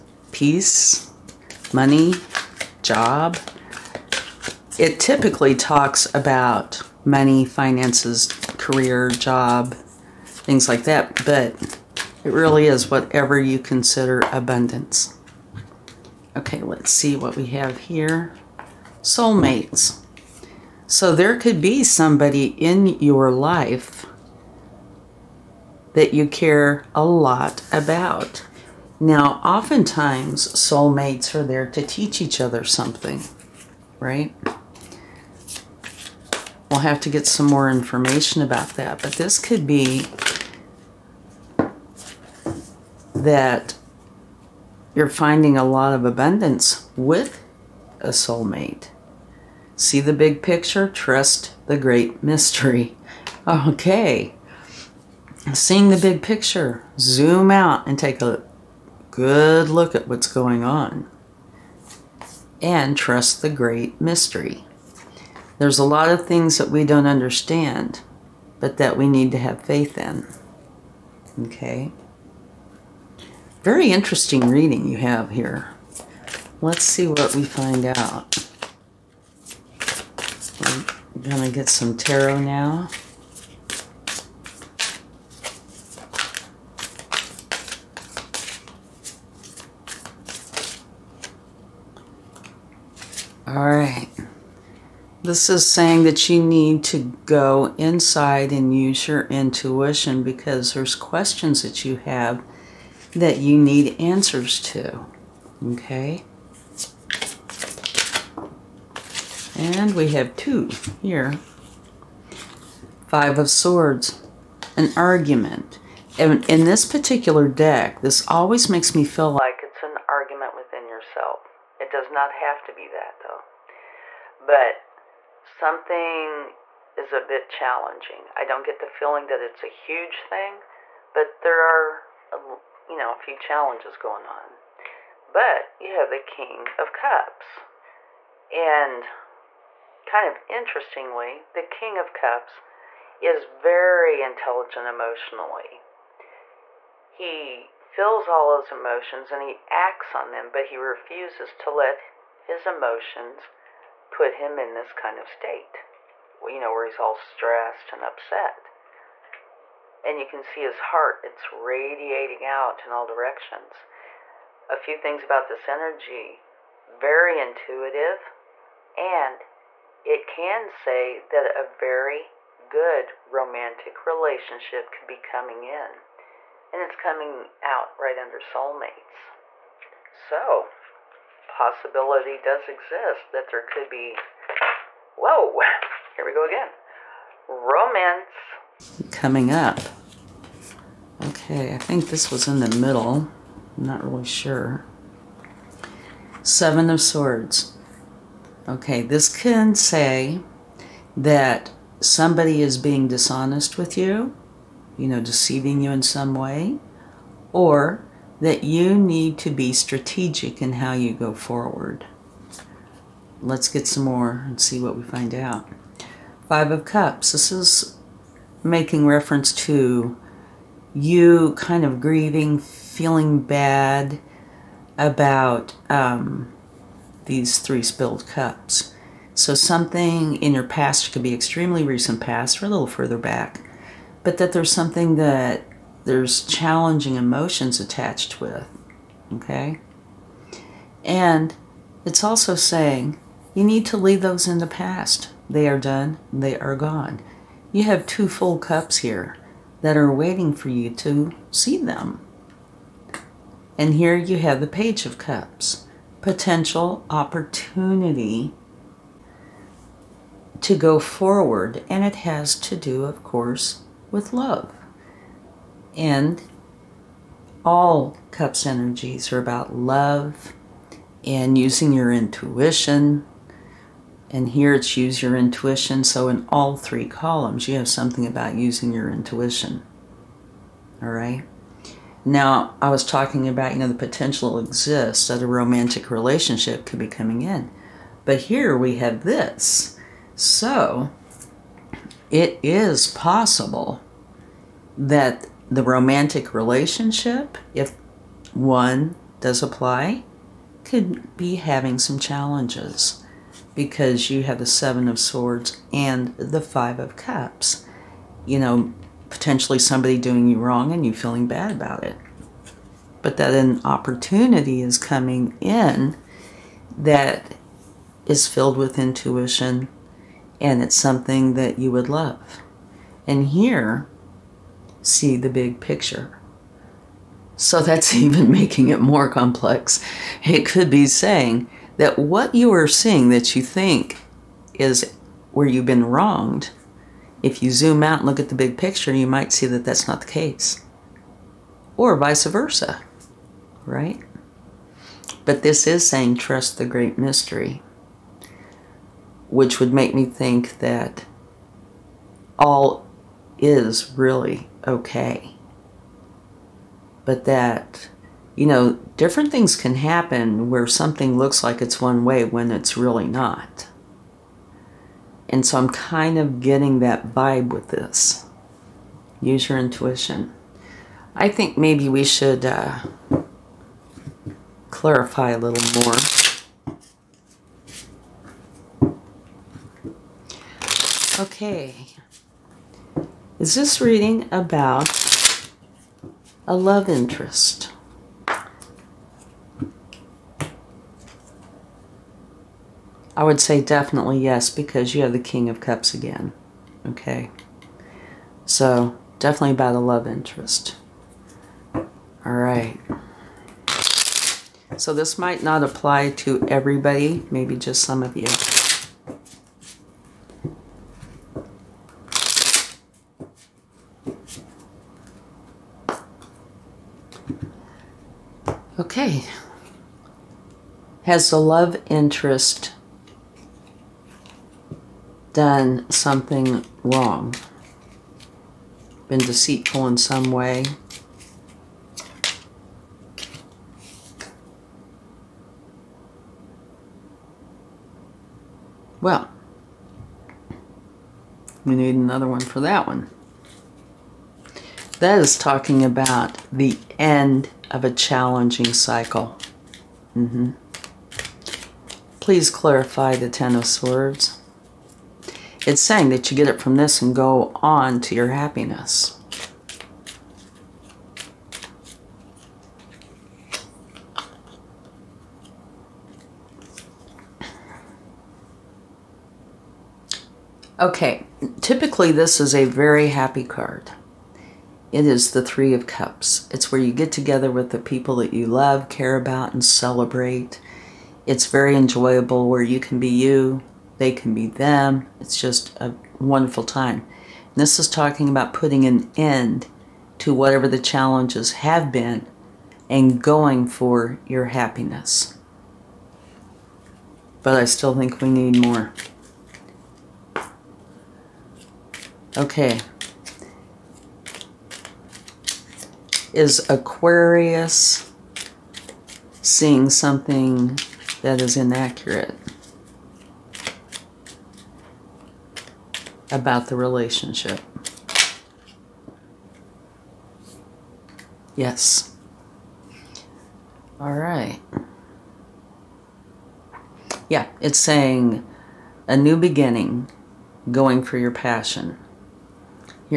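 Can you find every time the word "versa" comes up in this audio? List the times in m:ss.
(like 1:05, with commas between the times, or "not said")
5:42.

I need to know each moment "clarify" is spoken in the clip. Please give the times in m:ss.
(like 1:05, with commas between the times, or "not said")
6:14, 7:32.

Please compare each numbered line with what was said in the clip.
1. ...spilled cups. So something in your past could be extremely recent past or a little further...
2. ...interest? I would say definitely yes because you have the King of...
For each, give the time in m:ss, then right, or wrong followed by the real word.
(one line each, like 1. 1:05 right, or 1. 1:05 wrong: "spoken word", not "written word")
1. 3:47 right
2. 6:27 right.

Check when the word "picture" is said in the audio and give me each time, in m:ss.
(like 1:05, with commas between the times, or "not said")
0:50, 0:56, 5:25, 5:38.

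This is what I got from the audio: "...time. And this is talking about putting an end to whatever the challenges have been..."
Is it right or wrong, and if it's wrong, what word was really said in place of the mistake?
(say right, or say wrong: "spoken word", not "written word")
right.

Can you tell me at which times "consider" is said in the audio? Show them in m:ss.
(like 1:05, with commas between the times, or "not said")
0:13.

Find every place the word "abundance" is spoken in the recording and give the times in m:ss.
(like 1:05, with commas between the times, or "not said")
0:14, 0:46.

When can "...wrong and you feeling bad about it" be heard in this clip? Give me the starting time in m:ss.
5:10.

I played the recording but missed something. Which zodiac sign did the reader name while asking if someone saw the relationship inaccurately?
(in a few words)
Aquarius.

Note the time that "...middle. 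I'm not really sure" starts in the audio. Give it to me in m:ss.
3:12.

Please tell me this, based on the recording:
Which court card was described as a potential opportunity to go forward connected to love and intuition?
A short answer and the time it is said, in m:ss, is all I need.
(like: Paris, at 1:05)
Page of Cups, at 4:14.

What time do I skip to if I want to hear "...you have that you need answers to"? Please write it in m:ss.
1:41.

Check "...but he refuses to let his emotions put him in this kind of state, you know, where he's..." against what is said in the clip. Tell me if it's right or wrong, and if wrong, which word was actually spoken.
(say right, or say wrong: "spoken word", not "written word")
right.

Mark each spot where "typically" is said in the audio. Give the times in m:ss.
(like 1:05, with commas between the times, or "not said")
0:04, 7:51.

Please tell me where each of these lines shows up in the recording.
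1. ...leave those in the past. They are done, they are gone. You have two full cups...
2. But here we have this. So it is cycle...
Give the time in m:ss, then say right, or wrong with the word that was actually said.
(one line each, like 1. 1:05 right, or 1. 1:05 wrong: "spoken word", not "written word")
1. 4:03 right
2. 4:48 wrong: "possible", not "cycle".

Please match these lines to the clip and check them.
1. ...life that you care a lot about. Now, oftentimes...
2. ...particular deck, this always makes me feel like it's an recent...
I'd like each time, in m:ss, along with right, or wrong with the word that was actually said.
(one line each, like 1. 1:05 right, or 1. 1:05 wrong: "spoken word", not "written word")
1. 0:23 right
2. 1:56 wrong: "argument", not "recent".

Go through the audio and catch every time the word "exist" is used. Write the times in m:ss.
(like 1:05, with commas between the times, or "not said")
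3:02, 4:44.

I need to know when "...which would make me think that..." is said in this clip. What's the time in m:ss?
5:49.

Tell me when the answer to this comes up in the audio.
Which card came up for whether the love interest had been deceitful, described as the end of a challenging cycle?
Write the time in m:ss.
7:33.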